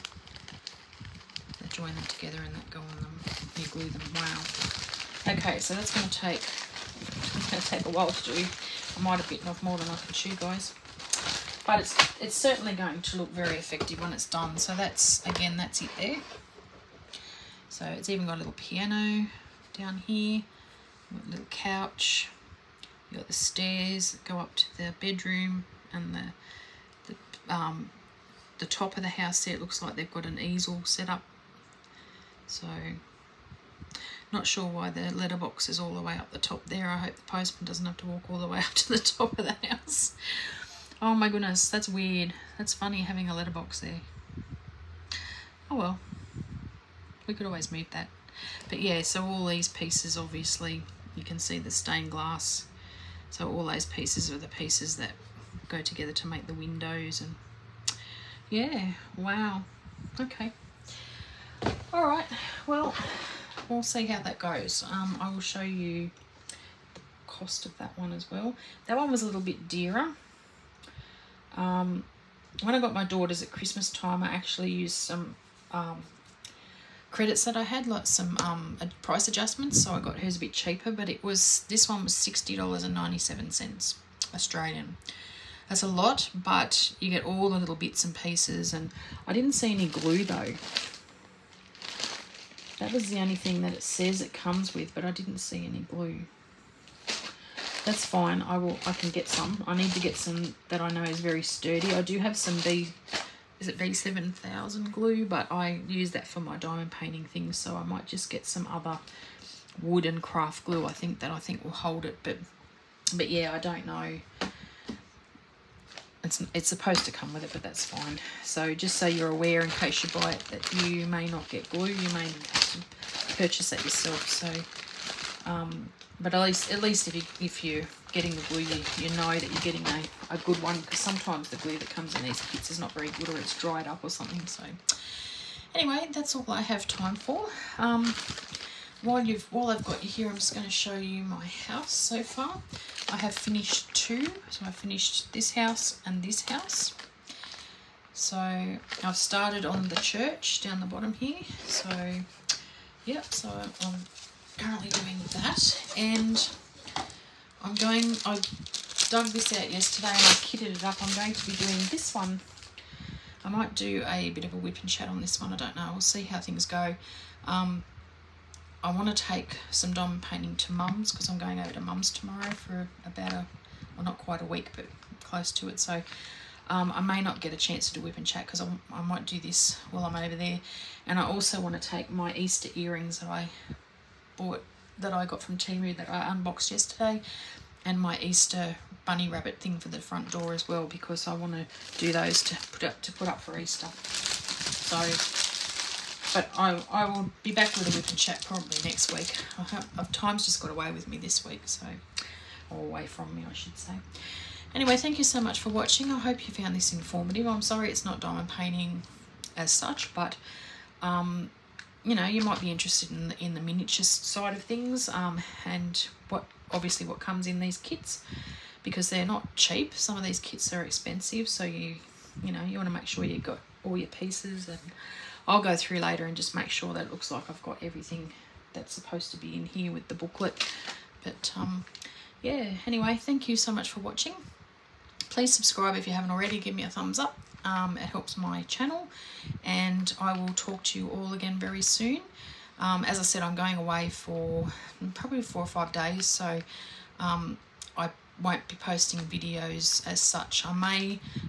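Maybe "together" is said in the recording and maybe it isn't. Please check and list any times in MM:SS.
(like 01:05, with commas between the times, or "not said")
00:02, 00:55.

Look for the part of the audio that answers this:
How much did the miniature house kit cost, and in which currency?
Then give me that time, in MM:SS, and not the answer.
01:22.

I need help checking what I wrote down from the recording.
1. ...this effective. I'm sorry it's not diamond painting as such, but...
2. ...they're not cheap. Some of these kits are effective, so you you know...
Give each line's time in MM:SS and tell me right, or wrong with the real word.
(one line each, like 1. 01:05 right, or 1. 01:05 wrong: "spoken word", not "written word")
1. 03:26 wrong: "informative", not "effective"
2. 03:39 wrong: "expensive", not "effective".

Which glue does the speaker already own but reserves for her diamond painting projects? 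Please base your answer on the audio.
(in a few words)
B7000.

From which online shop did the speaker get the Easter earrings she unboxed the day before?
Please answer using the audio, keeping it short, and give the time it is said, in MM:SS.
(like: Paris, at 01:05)
Temu, at 03:05.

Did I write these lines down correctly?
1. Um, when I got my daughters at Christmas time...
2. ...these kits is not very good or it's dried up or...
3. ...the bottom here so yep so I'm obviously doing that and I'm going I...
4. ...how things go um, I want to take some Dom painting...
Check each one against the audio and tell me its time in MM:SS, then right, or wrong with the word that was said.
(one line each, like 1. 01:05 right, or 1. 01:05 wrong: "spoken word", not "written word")
1. 01:11 right
2. 02:12 right
3. 02:30 wrong: "currently", not "obviously"
4. 02:46 right.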